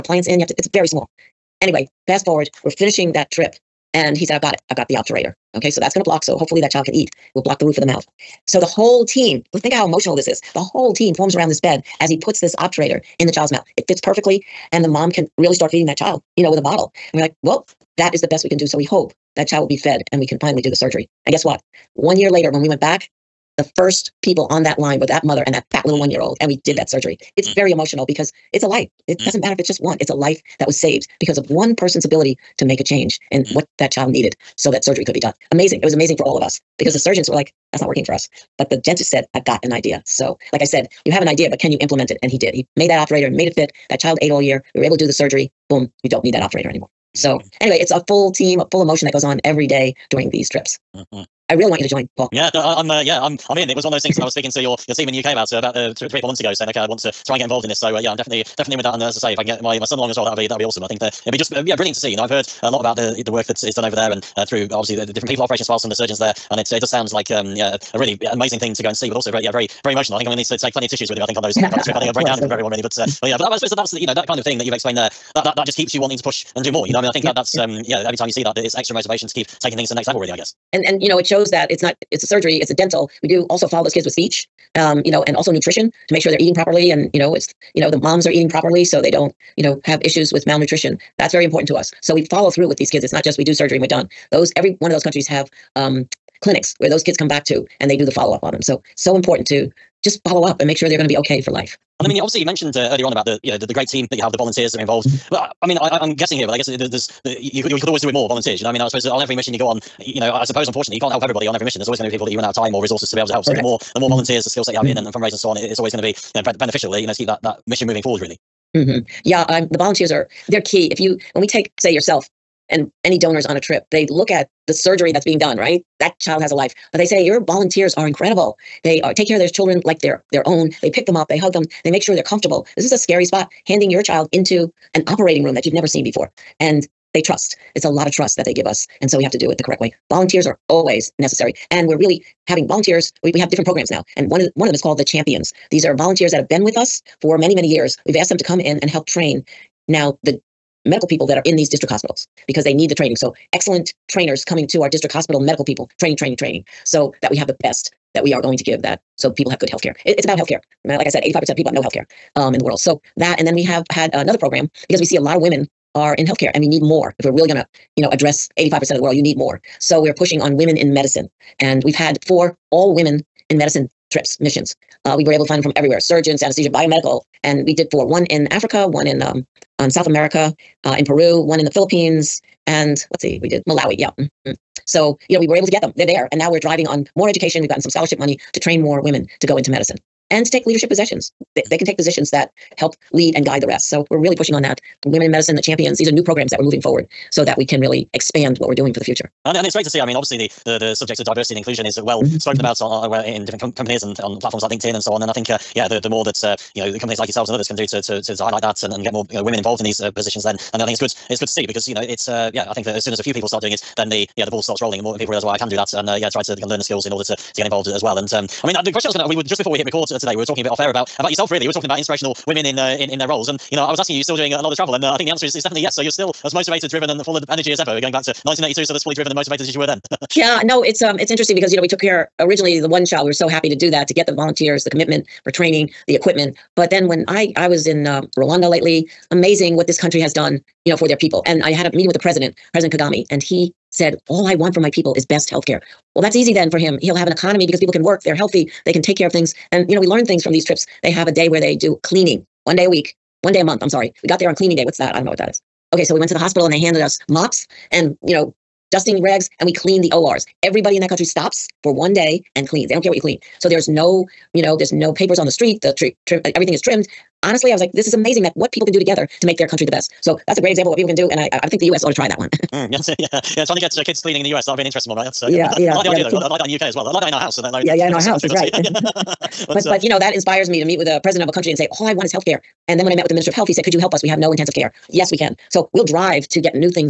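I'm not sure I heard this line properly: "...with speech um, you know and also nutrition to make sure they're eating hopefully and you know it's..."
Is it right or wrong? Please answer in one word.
wrong.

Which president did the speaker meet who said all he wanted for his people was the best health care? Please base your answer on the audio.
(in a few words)
President Kagame.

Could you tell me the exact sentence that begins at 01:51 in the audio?
There's always going to be people that you run out of time or resources to be able to help.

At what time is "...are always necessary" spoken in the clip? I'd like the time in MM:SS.
02:20.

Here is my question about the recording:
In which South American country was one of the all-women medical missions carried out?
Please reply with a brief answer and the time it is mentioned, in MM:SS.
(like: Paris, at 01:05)
Peru, at 03:01.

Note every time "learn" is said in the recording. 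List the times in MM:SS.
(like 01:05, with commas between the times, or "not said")
03:36, 04:10.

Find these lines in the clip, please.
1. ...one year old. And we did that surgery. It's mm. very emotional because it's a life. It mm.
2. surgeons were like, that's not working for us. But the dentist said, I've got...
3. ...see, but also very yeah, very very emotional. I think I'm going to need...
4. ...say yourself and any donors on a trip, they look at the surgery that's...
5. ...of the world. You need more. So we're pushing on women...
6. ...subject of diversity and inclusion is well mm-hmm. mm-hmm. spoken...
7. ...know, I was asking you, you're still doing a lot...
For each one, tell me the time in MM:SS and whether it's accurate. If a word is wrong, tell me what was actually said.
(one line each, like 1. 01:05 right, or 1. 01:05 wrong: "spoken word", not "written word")
1. 00:25 right
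2. 00:37 right
3. 01:08 right
4. 02:01 right
5. 02:48 right
6. 03:20 right
7. 03:43 right.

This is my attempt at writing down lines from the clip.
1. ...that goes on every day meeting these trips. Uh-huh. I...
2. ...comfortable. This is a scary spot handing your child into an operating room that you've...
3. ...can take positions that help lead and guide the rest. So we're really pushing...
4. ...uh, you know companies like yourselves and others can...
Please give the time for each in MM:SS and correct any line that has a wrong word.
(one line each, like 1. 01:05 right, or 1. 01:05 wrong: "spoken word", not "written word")
1. 00:49 wrong: "during", not "meeting"
2. 02:12 right
3. 03:11 right
4. 03:26 right.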